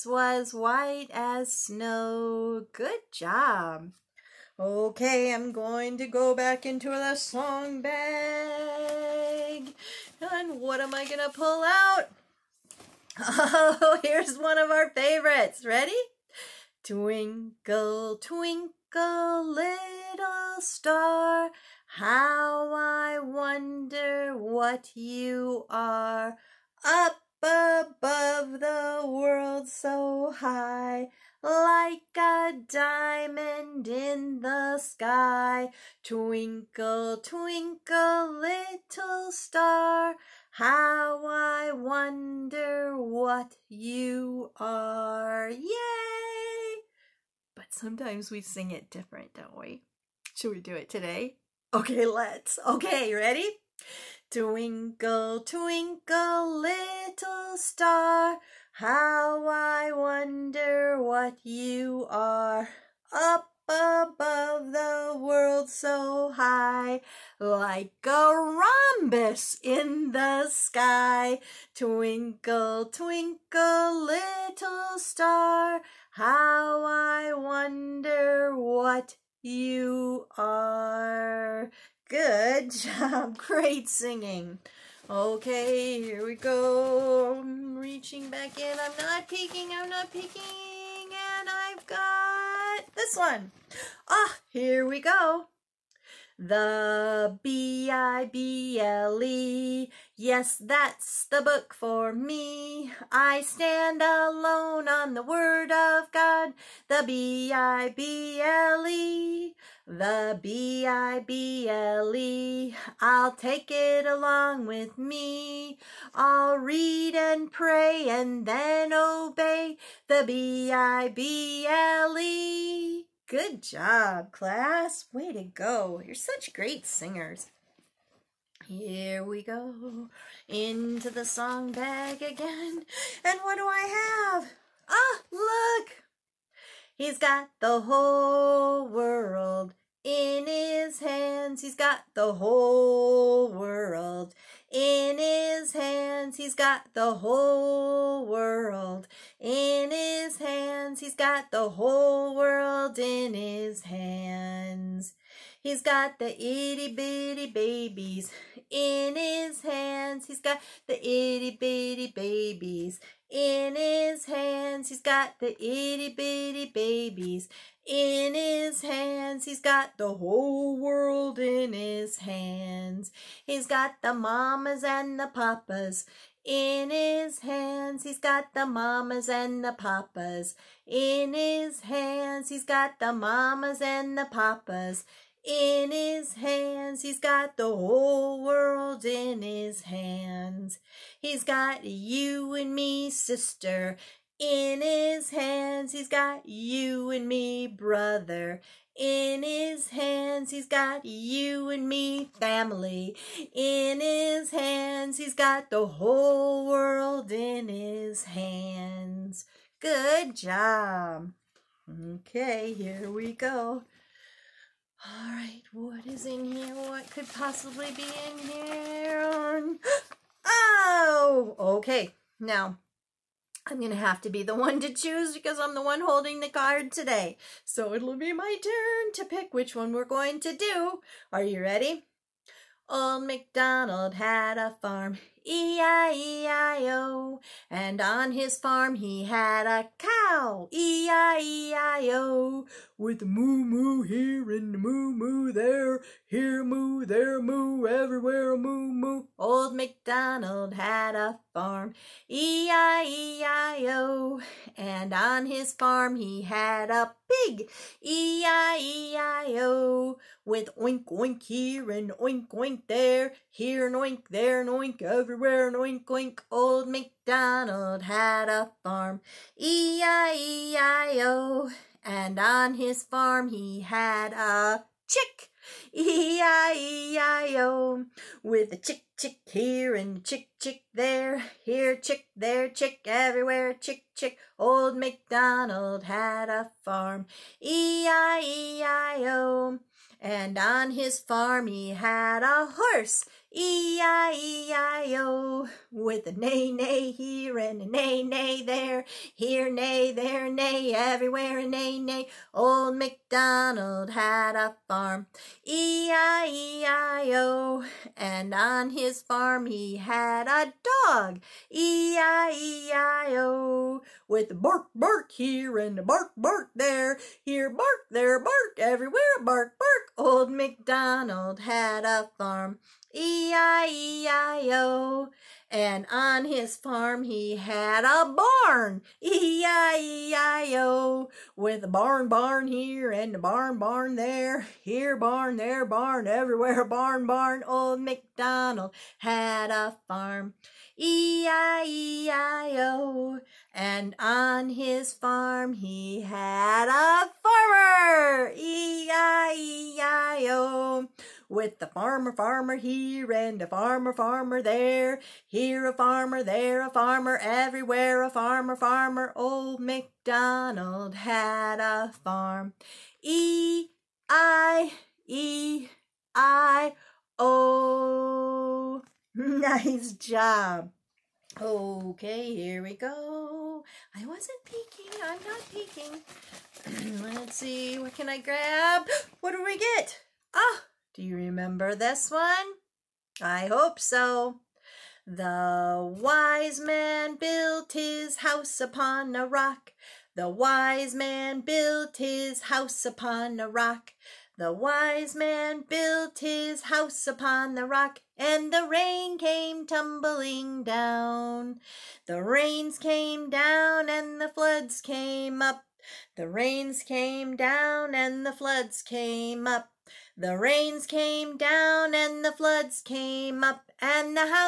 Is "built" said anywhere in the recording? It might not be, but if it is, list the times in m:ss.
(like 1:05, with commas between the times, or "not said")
6:27, 6:31, 6:35.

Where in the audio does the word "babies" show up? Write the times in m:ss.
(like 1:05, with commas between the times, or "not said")
2:37, 2:42, 2:46.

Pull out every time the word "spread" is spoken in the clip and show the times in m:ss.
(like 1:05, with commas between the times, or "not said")
not said.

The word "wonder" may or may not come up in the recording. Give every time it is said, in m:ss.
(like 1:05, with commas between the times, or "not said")
0:23, 0:41, 0:59, 1:17.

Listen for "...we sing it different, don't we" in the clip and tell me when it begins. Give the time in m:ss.
0:48.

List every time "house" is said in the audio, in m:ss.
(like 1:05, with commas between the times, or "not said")
6:28, 6:32, 6:36.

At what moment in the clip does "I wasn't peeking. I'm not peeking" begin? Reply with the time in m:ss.
6:14.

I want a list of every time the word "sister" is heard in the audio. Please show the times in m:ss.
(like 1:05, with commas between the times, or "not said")
3:13.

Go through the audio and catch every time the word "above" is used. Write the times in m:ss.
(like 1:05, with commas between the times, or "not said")
0:27, 1:03.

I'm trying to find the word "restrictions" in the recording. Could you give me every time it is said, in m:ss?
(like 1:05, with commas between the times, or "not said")
not said.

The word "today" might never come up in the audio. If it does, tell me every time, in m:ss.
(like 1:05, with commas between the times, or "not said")
0:50, 3:46.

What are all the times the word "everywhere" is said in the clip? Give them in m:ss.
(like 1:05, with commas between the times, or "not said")
4:07, 4:25, 4:43, 5:00, 5:18, 5:36, 5:57.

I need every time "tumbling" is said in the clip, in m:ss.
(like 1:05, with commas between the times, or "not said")
6:39.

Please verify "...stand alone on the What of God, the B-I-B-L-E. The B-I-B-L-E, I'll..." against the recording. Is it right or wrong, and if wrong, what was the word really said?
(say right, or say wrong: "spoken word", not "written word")
wrong: "Word", not "What".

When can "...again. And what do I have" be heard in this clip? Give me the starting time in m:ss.
2:12.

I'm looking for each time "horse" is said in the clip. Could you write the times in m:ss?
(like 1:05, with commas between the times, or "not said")
4:52.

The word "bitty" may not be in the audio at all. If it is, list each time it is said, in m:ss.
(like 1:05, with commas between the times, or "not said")
2:36, 2:41, 2:46.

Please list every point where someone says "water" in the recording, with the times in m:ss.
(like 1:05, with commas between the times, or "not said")
not said.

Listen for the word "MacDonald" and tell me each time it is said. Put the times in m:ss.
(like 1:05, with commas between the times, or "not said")
3:53, 4:09, 4:26, 4:44, 5:02, 5:20, 5:38, 5:59.